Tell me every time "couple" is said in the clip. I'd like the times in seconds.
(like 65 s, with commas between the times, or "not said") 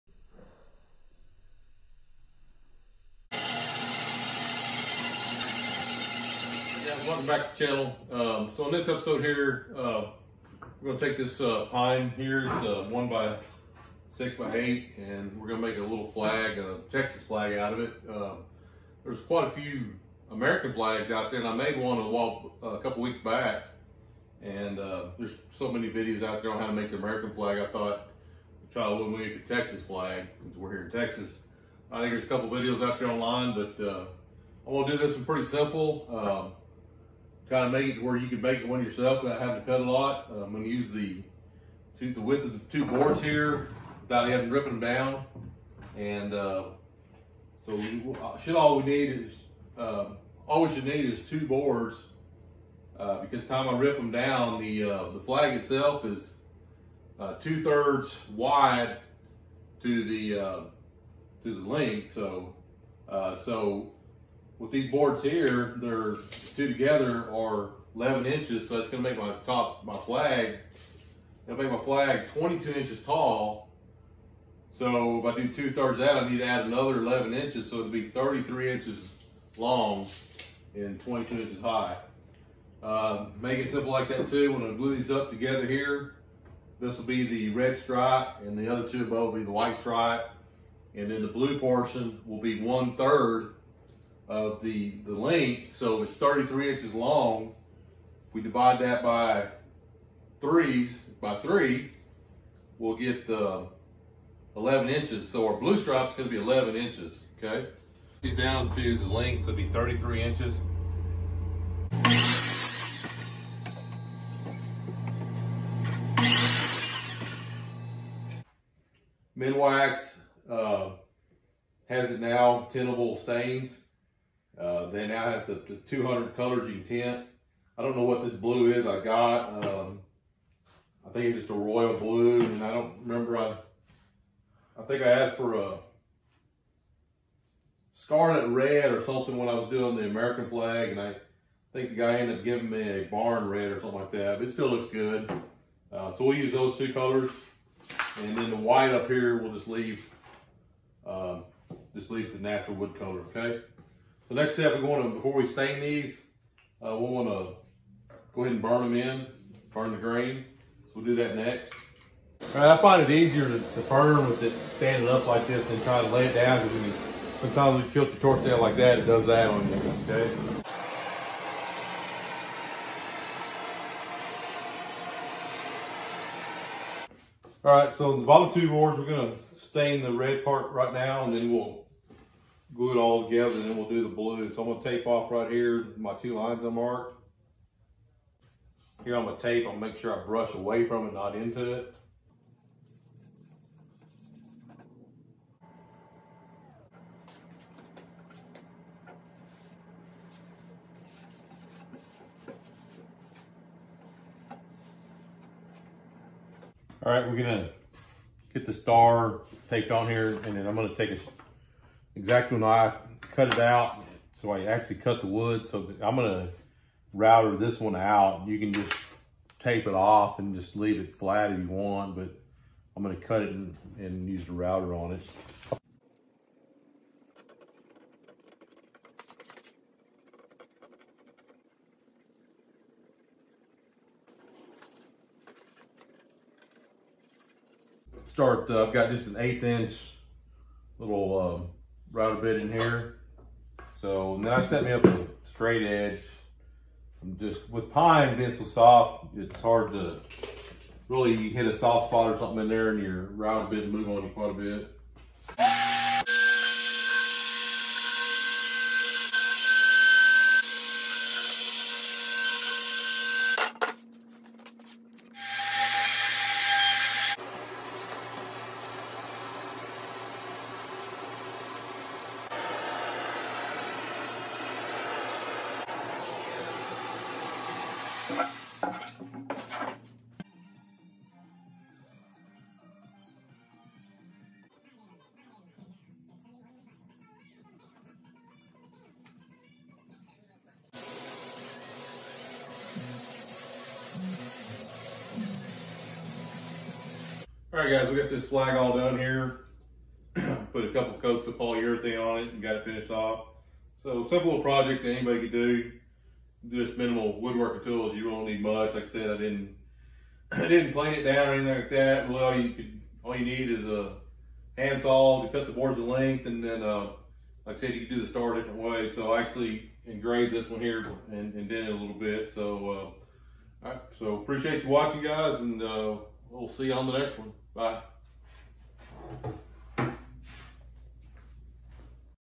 22 s, 32 s, 300 s.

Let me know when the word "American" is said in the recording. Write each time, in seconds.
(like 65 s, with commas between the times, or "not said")
20 s, 26 s, 140 s.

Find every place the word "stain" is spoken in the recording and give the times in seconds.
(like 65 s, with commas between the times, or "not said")
123 s, 155 s, 179 s.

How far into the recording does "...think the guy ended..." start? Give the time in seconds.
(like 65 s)
141 s.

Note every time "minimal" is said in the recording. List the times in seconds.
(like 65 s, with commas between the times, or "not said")
306 s.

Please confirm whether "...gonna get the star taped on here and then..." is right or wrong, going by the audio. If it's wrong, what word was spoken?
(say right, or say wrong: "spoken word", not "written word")
right.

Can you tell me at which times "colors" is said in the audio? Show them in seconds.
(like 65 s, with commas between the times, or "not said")
126 s, 146 s, 152 s.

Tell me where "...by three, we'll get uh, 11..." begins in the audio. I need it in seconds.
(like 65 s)
101 s.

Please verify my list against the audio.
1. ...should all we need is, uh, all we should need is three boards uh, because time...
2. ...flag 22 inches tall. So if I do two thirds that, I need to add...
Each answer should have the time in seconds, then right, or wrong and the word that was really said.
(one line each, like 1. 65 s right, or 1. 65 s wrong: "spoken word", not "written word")
1. 48 s wrong: "two", not "three"
2. 71 s right.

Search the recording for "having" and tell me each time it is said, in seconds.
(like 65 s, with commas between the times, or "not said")
39 s, 44 s.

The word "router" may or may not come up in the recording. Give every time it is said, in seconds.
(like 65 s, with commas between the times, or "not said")
217 s, 224 s, 253 s.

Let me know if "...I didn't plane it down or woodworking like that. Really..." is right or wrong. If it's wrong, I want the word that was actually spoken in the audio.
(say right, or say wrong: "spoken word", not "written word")
wrong: "anything", not "woodworking".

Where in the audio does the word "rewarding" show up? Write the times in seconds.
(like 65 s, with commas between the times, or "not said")
not said.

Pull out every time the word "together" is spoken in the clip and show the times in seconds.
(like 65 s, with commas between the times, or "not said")
66 s, 85 s, 183 s.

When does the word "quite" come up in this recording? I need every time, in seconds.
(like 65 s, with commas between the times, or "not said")
19 s, 254 s.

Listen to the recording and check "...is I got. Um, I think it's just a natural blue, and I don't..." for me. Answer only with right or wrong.
wrong.